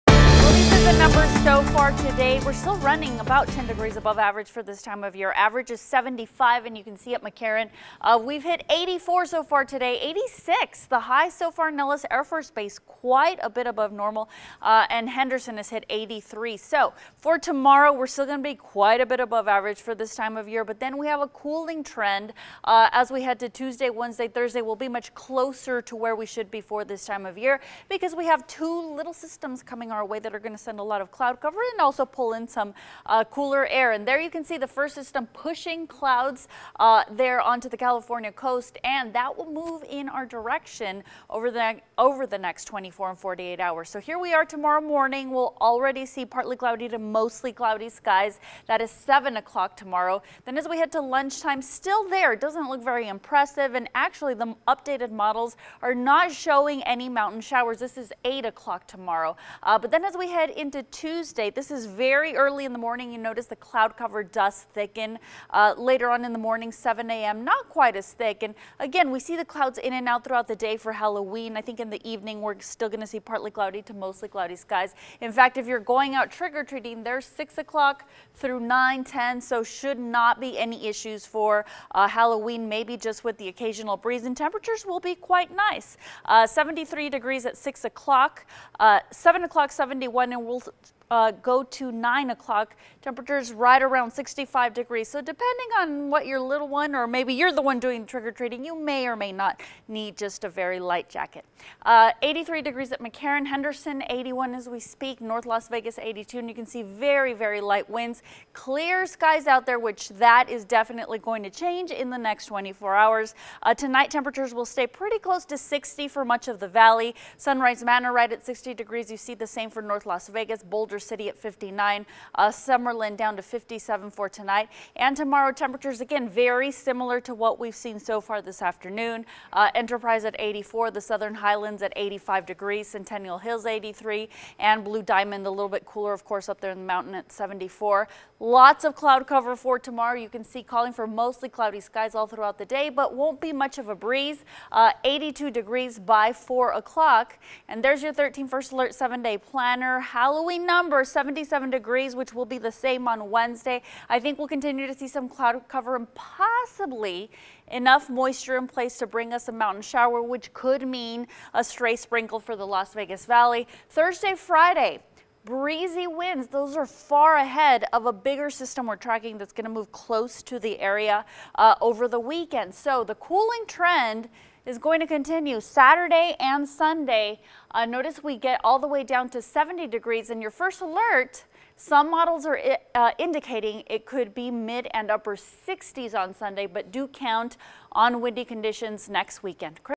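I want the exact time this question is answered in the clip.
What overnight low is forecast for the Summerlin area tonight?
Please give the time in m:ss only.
2:03.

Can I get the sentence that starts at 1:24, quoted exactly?
And temperatures will be quite nice.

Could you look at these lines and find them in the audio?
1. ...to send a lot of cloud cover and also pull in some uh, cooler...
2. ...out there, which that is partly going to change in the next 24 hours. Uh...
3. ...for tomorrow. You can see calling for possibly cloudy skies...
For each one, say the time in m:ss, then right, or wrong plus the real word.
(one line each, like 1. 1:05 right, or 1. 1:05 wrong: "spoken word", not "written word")
1. 0:30 right
2. 1:49 wrong: "definitely", not "partly"
3. 2:19 wrong: "mostly", not "possibly".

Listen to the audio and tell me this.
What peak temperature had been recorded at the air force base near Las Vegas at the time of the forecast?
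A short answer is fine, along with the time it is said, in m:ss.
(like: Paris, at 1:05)
86, at 0:10.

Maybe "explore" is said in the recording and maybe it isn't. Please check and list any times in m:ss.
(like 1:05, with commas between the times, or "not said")
not said.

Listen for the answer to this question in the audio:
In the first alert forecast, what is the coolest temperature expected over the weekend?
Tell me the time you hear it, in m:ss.
2:59.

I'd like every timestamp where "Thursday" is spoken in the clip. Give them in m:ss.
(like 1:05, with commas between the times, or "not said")
0:24, 2:43.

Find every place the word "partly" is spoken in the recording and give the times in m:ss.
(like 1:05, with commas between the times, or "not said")
0:46, 1:13.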